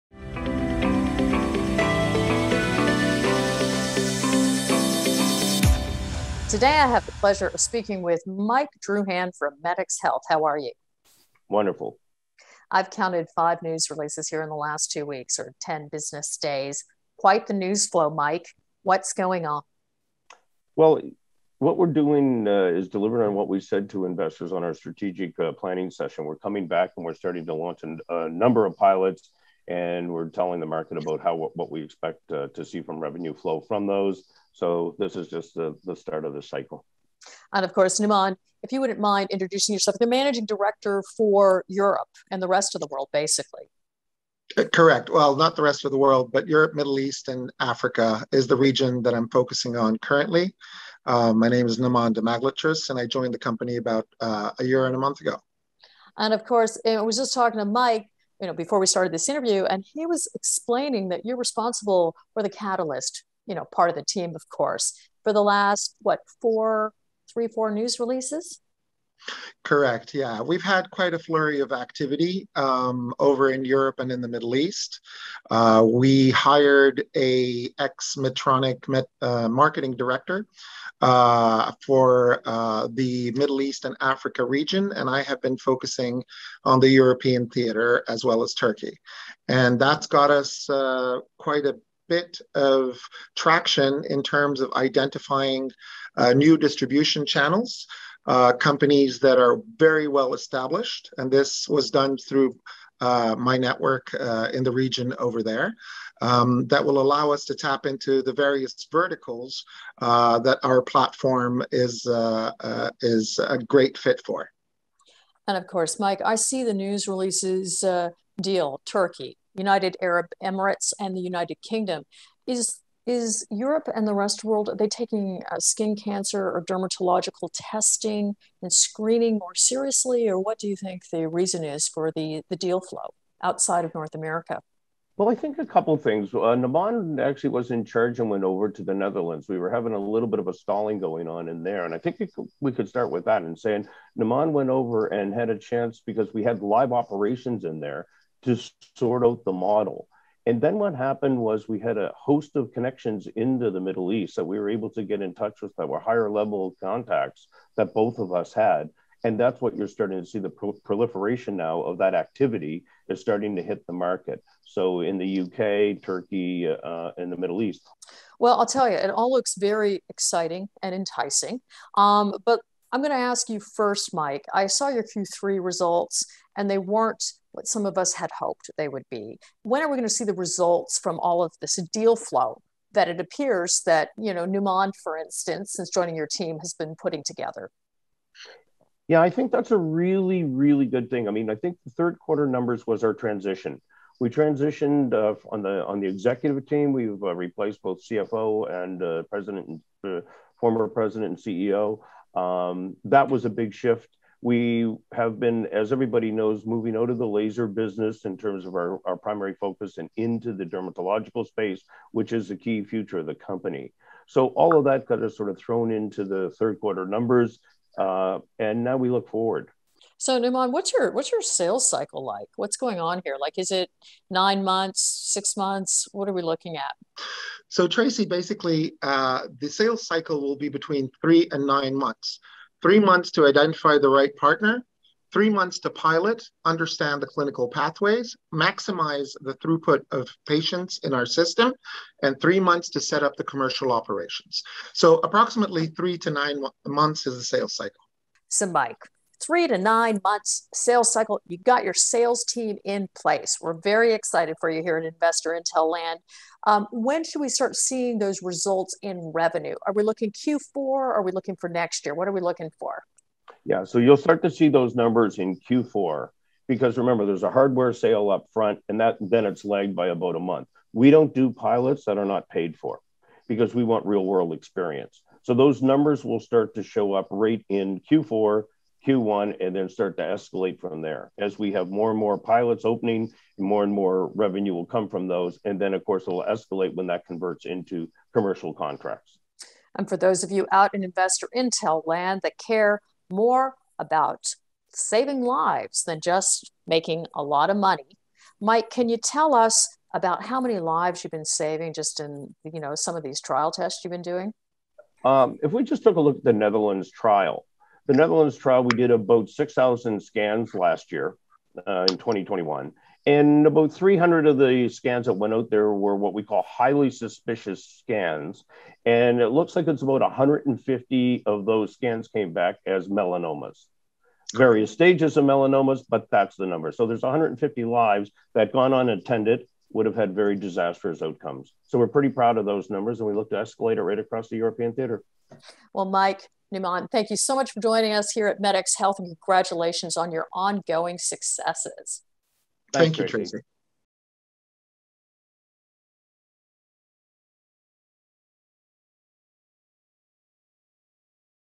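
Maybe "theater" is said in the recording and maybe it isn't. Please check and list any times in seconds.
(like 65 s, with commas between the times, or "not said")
87 s, 334 s.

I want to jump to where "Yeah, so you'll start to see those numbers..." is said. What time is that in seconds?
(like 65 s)
263 s.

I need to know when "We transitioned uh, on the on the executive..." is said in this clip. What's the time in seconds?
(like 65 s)
194 s.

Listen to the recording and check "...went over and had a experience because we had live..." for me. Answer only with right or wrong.
wrong.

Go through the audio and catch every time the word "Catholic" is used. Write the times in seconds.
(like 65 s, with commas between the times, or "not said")
not said.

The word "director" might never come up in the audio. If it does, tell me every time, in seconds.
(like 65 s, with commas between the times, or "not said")
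40 s, 79 s.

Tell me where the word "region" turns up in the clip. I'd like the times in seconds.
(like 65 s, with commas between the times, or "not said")
48 s, 84 s, 104 s.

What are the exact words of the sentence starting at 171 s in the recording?
Um, but I'm going to ask you first, Mike.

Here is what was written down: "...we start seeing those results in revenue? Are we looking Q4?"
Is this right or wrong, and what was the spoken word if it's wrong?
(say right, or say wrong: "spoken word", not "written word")
right.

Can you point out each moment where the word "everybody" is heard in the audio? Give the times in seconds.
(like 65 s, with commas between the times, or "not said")
205 s.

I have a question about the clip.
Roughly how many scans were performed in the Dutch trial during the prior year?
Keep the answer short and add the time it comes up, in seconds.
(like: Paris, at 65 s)
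6,000, at 309 s.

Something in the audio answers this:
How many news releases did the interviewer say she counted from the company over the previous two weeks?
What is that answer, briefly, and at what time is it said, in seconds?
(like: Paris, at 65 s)
5, at 13 s.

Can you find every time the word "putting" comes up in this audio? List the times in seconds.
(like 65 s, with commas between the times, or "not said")
187 s.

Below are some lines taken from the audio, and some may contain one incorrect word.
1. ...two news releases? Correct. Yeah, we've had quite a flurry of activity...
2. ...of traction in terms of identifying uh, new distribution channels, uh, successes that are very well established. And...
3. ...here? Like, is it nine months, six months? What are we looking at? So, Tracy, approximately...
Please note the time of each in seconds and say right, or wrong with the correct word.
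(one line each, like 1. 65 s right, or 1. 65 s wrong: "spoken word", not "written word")
1. 67 s wrong: "four", not "two"
2. 92 s wrong: "companies", not "successes"
3. 223 s wrong: "basically", not "approximately".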